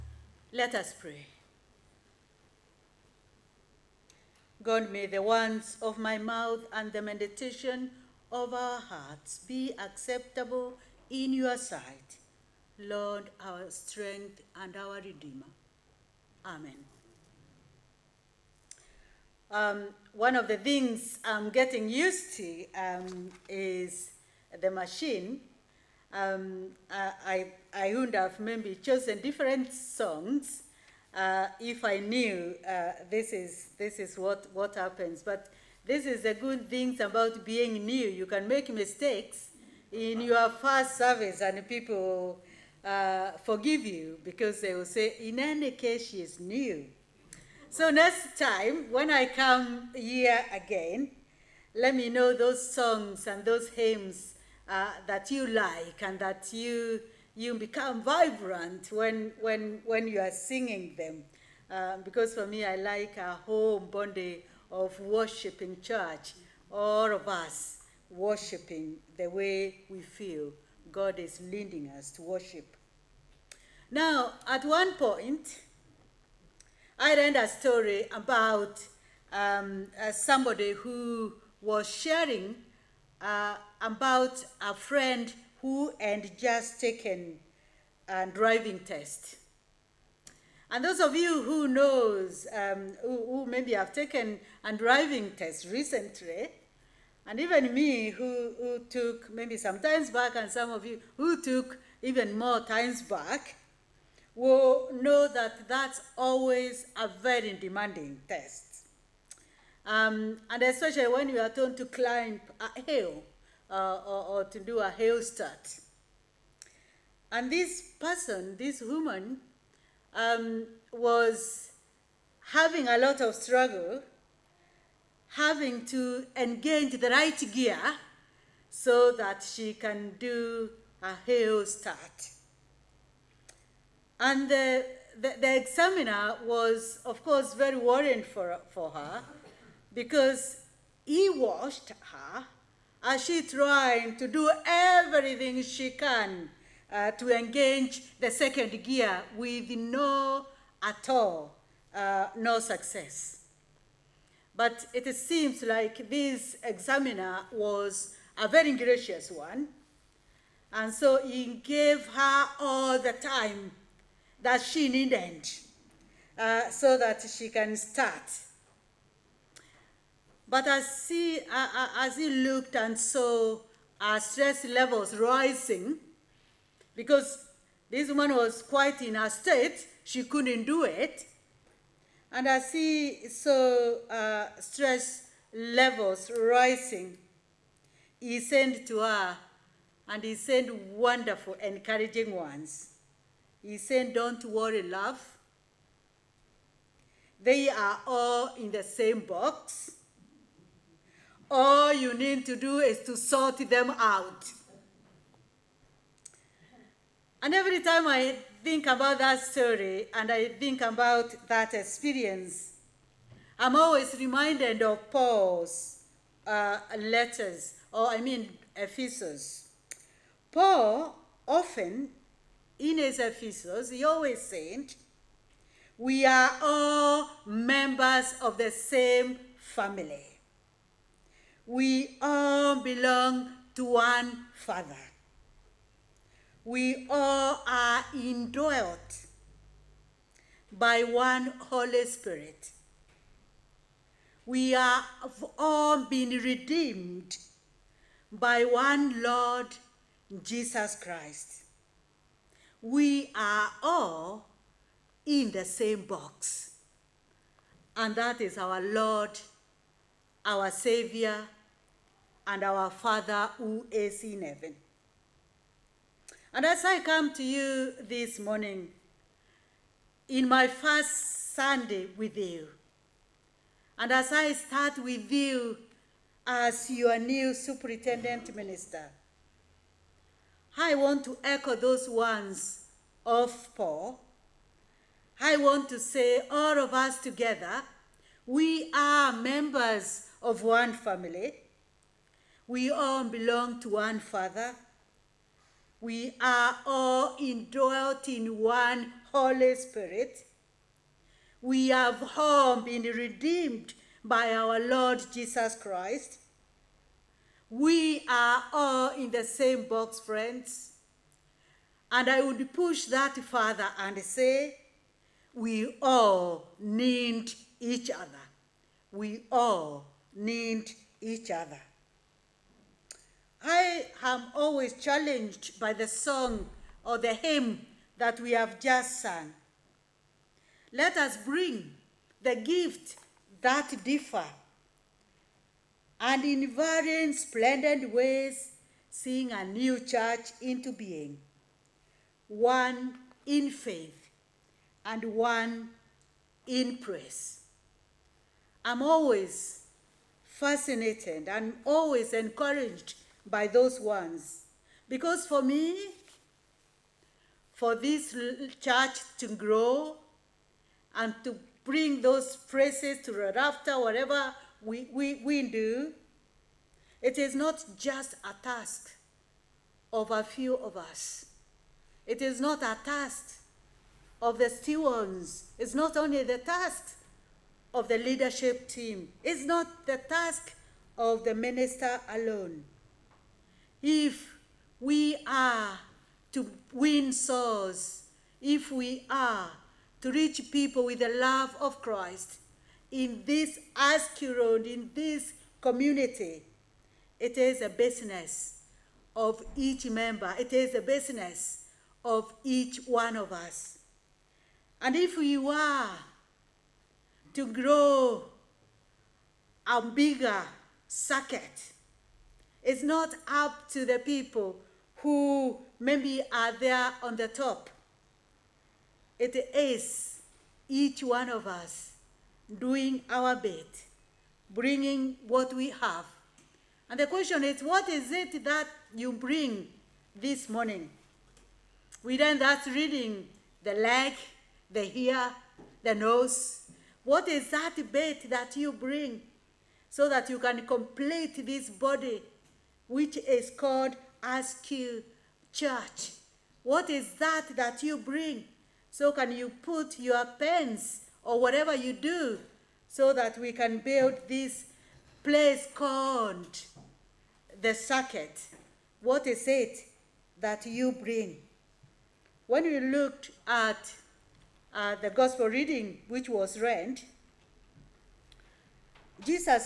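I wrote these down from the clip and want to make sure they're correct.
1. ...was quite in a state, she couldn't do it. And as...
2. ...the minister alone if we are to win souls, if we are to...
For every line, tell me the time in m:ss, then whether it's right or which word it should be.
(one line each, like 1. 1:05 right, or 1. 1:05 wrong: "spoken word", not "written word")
1. 2:58 right
2. 6:21 right.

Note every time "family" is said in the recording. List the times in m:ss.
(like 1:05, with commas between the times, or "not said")
3:49, 4:50.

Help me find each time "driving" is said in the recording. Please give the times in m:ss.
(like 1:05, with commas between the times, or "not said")
1:28, 1:34.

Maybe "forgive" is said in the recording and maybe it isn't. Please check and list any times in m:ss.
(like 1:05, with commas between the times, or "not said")
0:43.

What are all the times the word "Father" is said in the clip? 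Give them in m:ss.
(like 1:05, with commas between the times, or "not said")
3:54, 4:22, 4:54.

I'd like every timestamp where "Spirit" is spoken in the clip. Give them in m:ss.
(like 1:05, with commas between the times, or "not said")
4:02, 4:59.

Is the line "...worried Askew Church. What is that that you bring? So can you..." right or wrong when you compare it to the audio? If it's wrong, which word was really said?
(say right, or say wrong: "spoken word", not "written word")
wrong: "called", not "worried".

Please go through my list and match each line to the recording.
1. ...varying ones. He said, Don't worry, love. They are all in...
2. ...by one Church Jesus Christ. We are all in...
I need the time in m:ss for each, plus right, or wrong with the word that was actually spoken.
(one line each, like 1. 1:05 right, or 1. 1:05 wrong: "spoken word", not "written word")
1. 3:11 wrong: "encouraging", not "varying"
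2. 4:08 wrong: "Lord", not "Church".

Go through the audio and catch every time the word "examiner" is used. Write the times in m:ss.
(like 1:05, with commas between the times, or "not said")
2:15, 2:36.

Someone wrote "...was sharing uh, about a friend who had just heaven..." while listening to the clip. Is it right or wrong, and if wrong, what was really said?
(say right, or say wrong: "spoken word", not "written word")
wrong: "taken", not "heaven".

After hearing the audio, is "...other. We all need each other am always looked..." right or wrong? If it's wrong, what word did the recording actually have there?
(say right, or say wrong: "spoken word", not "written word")
wrong: "challenged", not "looked".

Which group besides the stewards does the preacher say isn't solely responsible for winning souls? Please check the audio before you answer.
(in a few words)
the leadership team.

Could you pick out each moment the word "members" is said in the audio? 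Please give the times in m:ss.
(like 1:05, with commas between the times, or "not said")
3:47, 4:49, 6:40.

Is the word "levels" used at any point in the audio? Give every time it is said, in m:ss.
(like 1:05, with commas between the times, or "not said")
2:54, 3:05.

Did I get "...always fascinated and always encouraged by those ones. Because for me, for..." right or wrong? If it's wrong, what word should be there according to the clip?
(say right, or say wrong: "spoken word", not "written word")
right.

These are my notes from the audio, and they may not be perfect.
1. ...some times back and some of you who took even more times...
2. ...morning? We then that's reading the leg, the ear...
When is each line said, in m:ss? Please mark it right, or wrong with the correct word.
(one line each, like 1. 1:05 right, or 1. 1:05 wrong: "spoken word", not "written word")
1. 1:39 right
2. 7:10 right.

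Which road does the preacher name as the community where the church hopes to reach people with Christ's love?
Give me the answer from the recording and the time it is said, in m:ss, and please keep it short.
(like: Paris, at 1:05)
Askew Road, at 6:33.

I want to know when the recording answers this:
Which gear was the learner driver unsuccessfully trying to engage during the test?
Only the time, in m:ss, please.
2:28.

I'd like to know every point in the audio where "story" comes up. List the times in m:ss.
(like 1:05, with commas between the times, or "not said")
1:17, 3:29.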